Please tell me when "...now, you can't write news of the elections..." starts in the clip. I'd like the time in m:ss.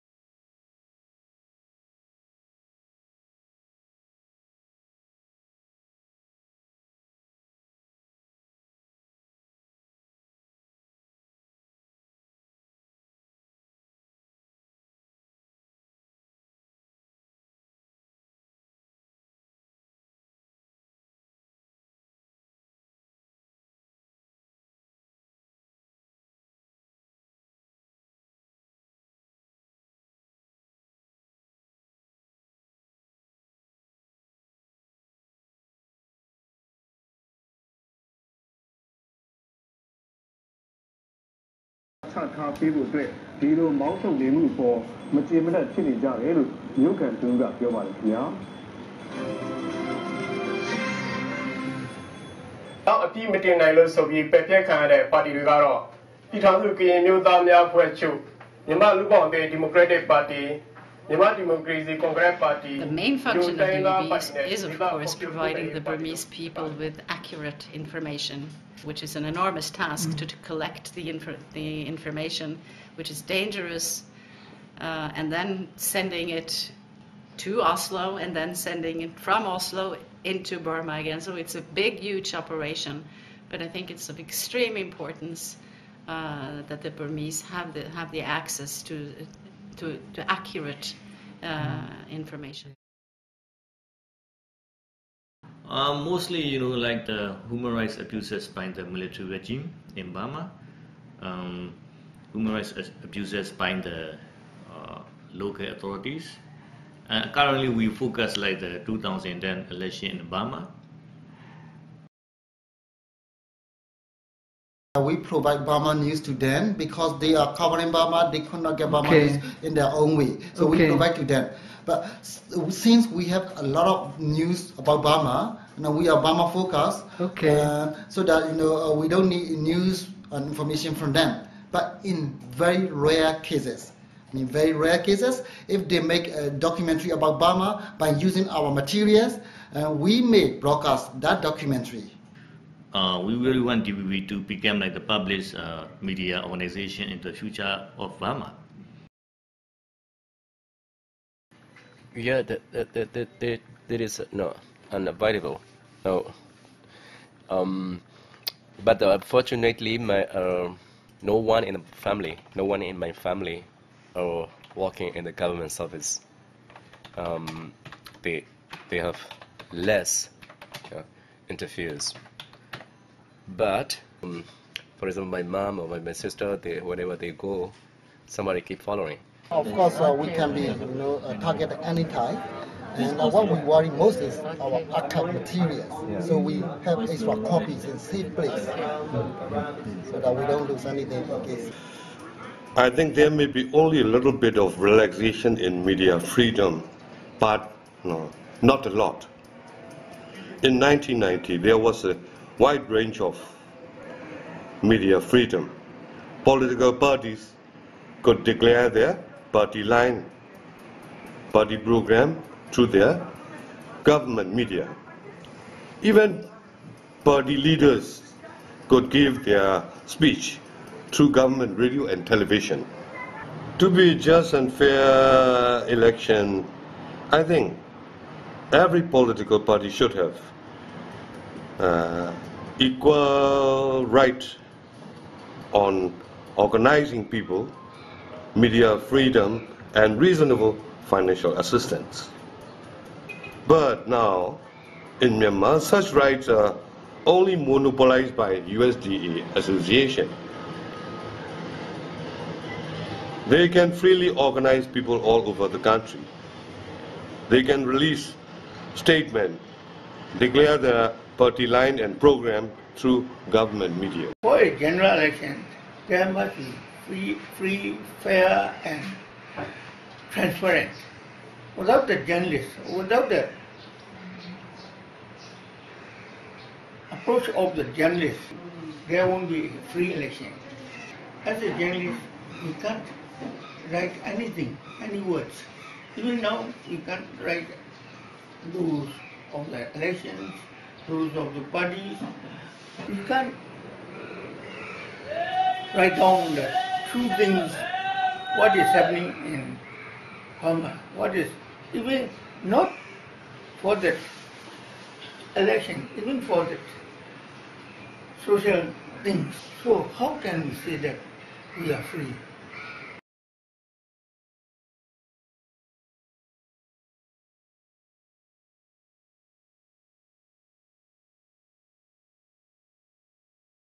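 4:46.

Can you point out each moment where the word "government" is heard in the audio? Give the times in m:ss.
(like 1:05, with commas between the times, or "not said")
2:45, 3:34, 3:41, 4:23.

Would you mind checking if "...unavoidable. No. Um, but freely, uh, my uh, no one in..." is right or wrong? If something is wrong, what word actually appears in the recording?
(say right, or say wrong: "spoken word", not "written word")
wrong: "unfortunately", not "freely".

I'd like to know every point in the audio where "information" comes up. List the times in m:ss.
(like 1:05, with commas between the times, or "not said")
1:07, 1:11, 1:32, 2:10.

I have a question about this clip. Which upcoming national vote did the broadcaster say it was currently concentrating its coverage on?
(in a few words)
2010 election.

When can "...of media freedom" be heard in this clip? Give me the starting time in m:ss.
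3:23.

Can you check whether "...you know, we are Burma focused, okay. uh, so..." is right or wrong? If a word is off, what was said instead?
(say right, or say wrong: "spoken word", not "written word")
right.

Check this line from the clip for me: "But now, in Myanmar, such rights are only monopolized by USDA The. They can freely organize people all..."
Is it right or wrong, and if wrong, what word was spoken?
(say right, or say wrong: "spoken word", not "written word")
wrong: "Association", not "The".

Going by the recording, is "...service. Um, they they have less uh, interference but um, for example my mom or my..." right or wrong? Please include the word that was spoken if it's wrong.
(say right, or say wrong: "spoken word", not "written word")
right.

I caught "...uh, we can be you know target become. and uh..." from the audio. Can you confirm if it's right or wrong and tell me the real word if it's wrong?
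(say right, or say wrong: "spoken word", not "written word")
wrong: "anytime", not "become".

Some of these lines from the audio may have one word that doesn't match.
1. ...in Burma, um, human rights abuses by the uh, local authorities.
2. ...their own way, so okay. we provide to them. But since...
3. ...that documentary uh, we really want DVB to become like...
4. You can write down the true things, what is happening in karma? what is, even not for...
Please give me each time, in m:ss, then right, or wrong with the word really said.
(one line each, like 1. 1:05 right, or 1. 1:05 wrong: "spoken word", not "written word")
1. 1:39 right
2. 1:59 right
3. 2:21 right
4. 4:53 right.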